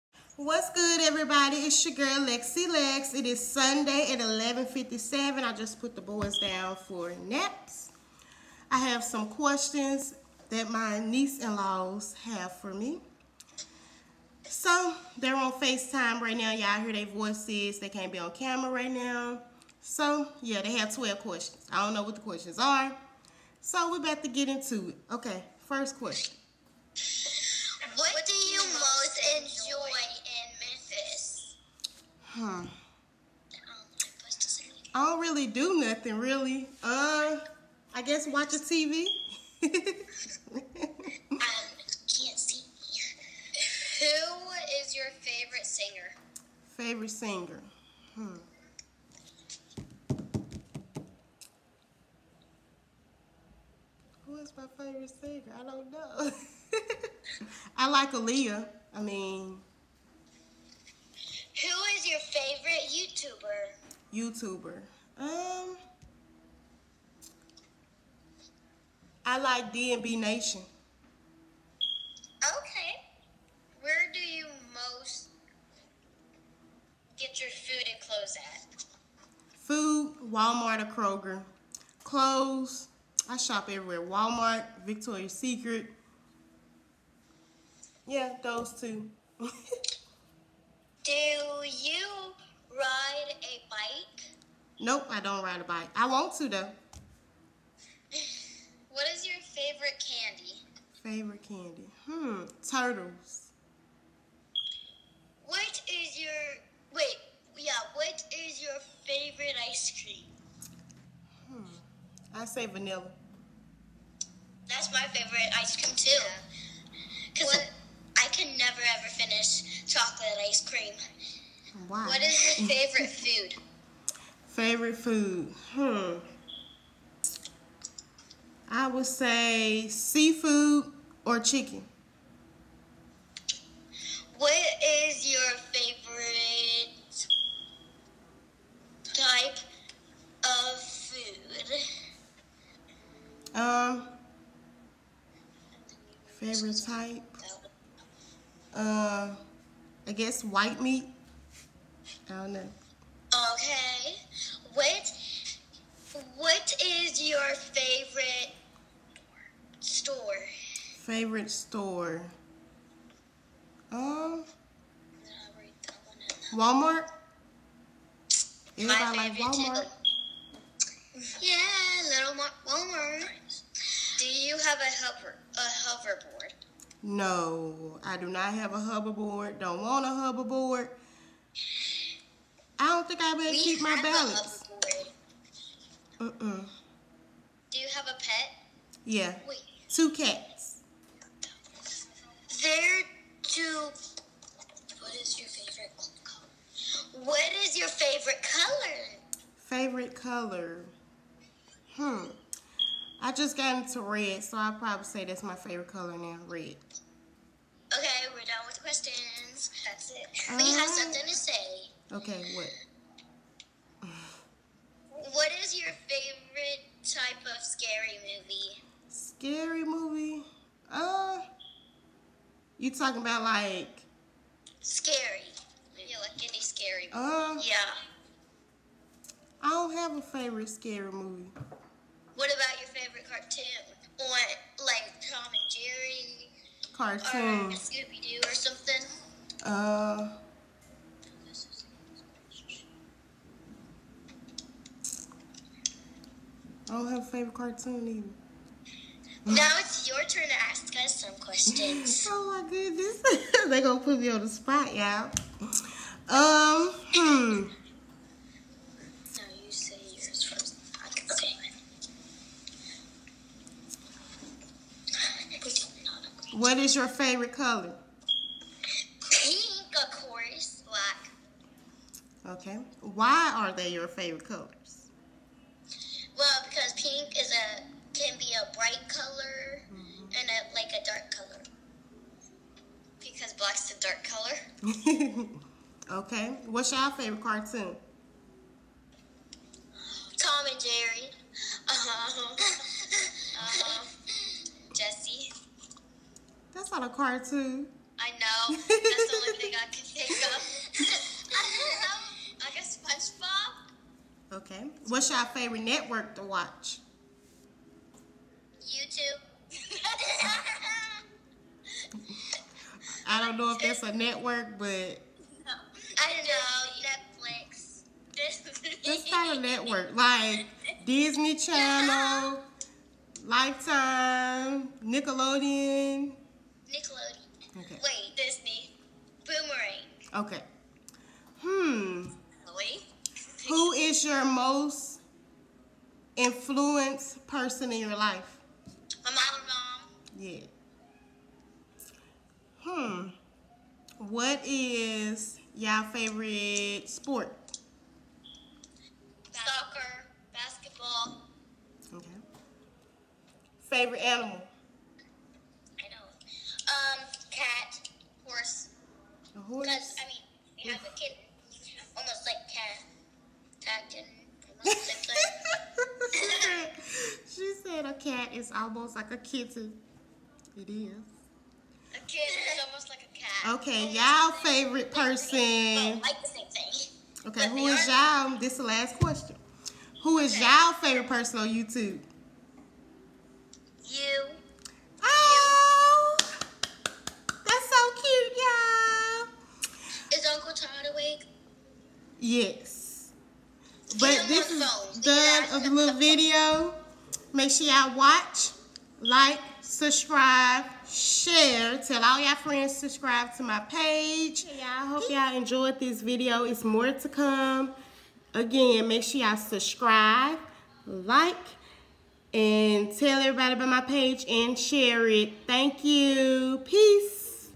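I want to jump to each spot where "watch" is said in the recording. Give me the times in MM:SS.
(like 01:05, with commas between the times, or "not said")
00:38, 05:06, 06:38.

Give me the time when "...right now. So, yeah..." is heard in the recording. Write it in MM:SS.
00:18.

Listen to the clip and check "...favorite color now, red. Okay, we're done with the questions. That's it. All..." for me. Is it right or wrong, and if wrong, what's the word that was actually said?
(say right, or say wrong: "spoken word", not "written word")
right.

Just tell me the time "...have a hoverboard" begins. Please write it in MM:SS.
02:58.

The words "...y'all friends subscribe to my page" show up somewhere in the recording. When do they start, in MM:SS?
06:42.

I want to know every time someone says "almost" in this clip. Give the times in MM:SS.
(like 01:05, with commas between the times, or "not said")
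06:02, 06:08.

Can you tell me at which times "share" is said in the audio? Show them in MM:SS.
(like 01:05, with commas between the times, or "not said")
06:41, 06:54.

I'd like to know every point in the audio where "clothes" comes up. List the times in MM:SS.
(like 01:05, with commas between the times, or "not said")
01:18, 01:22.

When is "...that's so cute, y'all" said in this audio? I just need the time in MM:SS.
06:26.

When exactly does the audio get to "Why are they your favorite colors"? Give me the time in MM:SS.
04:33.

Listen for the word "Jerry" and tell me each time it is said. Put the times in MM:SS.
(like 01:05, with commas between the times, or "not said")
03:55, 04:50.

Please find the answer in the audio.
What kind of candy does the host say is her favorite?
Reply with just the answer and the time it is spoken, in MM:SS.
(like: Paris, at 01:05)
Turtles, at 01:42.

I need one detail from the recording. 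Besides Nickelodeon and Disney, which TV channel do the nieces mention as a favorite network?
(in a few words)
Boomerang.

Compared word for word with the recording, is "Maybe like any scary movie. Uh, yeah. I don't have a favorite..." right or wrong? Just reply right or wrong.
right.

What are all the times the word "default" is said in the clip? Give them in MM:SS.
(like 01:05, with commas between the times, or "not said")
not said.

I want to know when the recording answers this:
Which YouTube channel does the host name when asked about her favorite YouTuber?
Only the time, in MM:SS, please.
01:09.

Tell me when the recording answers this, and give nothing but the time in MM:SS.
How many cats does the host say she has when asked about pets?
03:09.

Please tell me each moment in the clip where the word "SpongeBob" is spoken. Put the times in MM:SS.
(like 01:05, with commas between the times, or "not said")
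05:02.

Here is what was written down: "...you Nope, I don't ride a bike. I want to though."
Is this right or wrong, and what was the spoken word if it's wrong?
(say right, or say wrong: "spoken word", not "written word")
right.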